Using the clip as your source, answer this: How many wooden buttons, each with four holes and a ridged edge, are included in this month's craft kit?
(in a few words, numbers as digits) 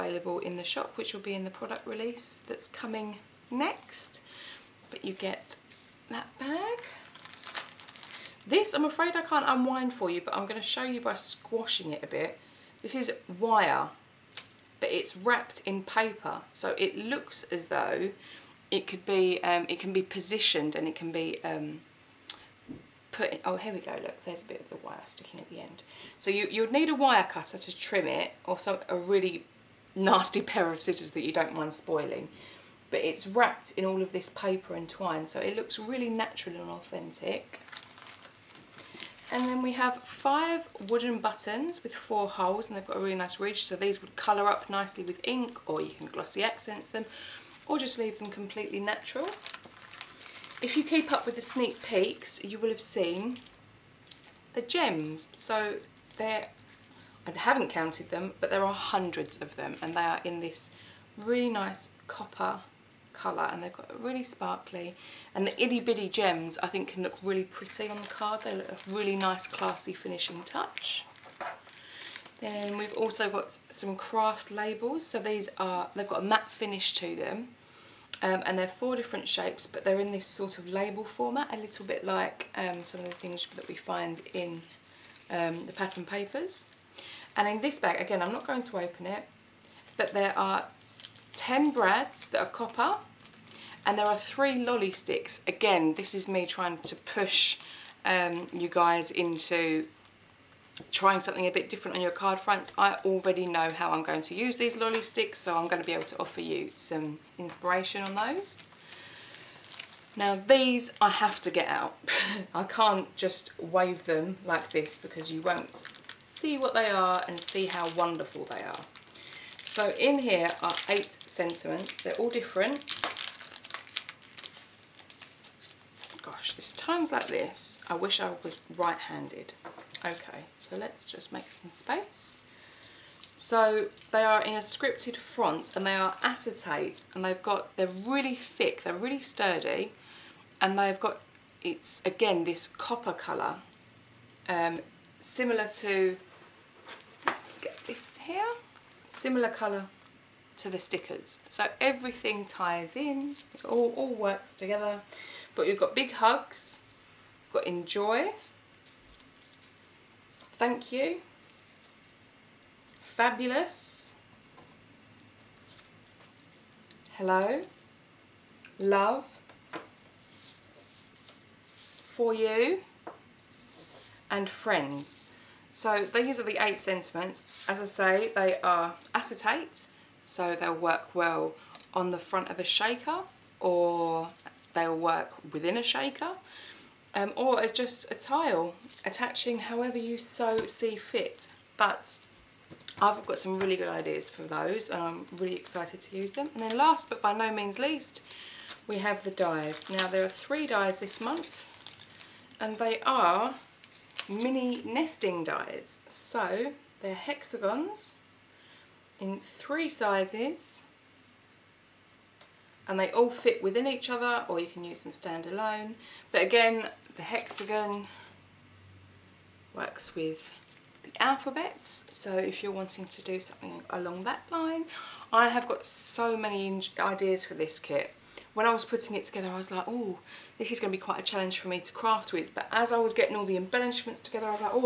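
5.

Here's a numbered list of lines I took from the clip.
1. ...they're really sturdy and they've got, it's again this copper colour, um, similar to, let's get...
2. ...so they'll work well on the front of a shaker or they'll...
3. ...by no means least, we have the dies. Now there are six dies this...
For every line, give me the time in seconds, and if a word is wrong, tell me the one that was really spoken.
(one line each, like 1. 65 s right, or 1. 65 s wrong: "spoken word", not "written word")
1. 138 s right
2. 180 s right
3. 197 s wrong: "three", not "six".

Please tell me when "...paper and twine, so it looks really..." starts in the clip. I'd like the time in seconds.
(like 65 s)
34 s.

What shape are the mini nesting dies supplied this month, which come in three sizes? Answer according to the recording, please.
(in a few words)
Hexagons.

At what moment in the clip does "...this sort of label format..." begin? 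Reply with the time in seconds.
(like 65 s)
80 s.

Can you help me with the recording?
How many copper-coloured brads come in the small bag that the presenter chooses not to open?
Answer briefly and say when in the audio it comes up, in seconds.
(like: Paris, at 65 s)
10, at 91 s.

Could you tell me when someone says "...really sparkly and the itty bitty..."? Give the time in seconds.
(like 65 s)
63 s.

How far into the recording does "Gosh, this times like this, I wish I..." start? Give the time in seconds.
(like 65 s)
126 s.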